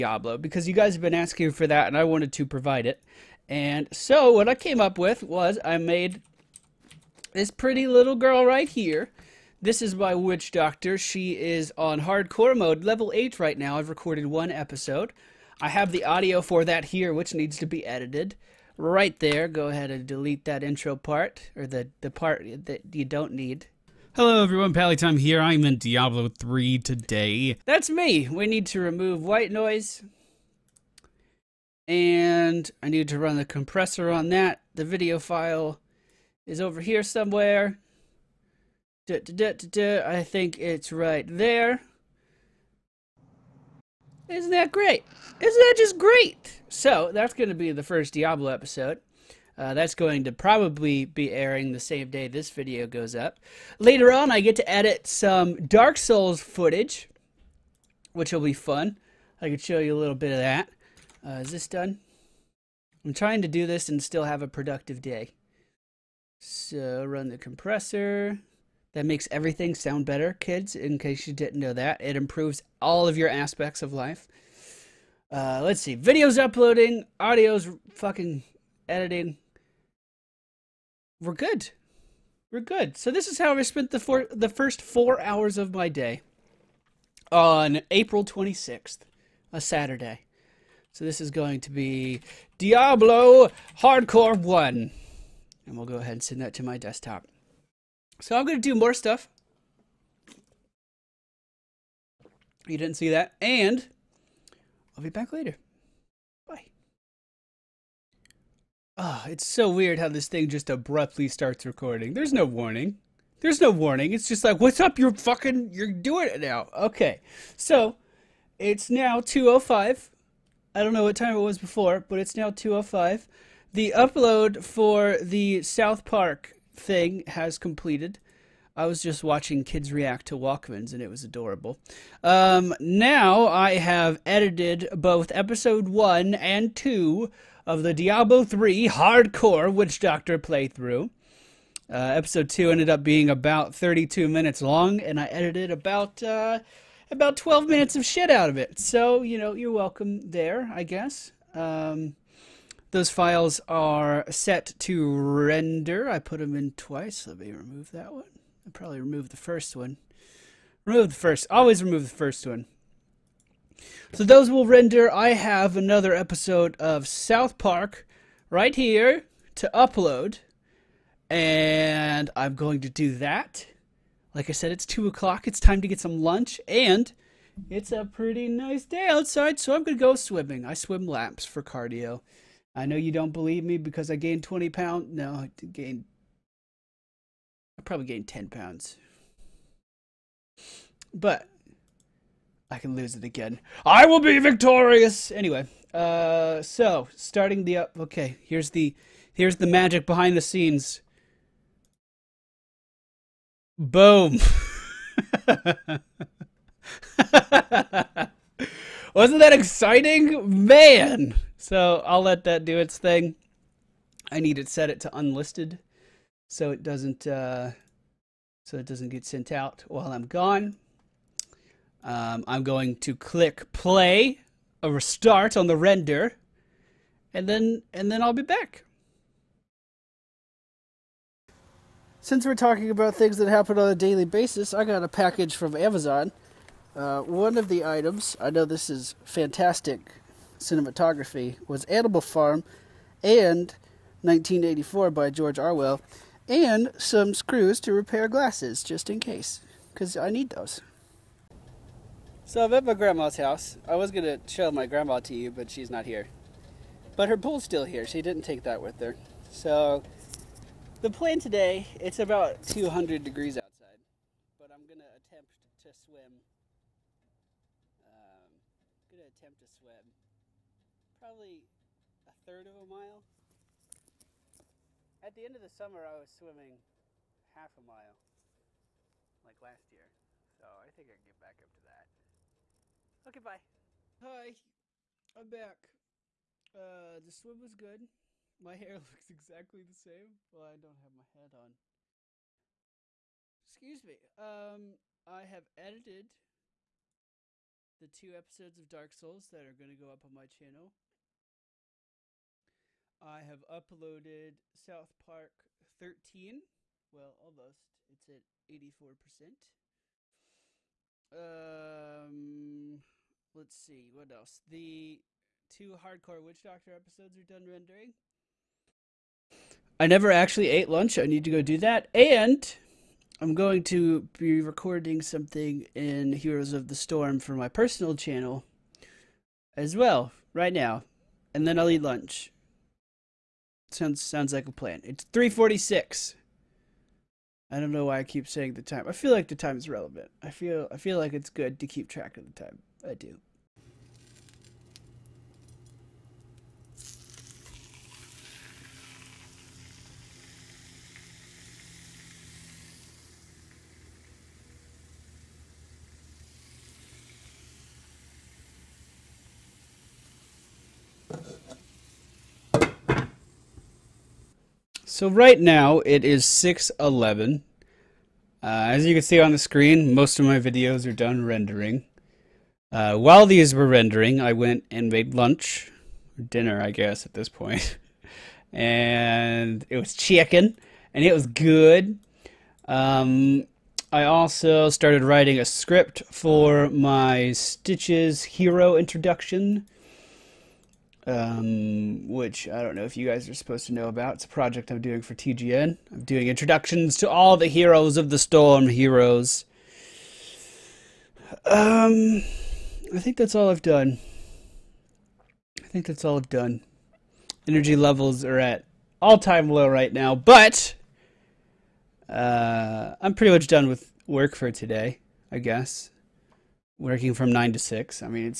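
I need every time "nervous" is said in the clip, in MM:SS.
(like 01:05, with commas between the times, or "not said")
not said.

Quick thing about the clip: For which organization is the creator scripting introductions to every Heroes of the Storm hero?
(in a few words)
TGN.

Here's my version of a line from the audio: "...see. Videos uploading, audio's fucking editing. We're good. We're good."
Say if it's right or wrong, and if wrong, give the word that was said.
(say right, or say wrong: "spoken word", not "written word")
right.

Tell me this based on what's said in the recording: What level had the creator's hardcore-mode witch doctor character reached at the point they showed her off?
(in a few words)
8.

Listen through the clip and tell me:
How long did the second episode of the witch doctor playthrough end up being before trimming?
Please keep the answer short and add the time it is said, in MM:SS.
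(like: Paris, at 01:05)
32 minutes, at 02:23.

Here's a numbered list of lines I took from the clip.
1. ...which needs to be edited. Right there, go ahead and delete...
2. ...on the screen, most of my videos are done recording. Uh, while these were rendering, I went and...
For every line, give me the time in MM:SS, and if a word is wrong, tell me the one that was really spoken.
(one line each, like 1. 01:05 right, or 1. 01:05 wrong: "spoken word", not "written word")
1. 00:17 right
2. 06:09 wrong: "rendering", not "recording".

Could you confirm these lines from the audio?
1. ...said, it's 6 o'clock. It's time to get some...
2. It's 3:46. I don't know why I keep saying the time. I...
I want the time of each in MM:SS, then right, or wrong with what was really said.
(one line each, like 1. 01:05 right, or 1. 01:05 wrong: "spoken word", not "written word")
1. 02:54 wrong: "2", not "6"
2. 05:35 right.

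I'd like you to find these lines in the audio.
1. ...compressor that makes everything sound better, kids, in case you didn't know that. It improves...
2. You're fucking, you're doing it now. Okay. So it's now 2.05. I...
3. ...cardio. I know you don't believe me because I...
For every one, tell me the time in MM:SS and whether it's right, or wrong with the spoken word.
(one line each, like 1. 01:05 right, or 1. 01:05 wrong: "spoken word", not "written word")
1. 01:07 right
2. 01:54 right
3. 03:01 right.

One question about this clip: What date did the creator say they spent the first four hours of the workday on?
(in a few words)
April 26th.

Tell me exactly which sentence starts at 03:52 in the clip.
Since we're talking about things that happen on a daily basis, I got a package from Amazon.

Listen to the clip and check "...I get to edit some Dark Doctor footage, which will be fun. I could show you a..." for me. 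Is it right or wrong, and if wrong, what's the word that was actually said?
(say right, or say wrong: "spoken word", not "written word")
wrong: "Souls", not "Doctor".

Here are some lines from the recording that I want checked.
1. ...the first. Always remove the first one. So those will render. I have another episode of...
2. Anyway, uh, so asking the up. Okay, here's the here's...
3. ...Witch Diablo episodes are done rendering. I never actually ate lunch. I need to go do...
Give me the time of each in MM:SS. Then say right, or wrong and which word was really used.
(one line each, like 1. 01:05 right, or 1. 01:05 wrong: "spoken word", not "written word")
1. 02:41 right
2. 03:15 wrong: "starting", not "asking"
3. 05:16 wrong: "Doctor", not "Diablo".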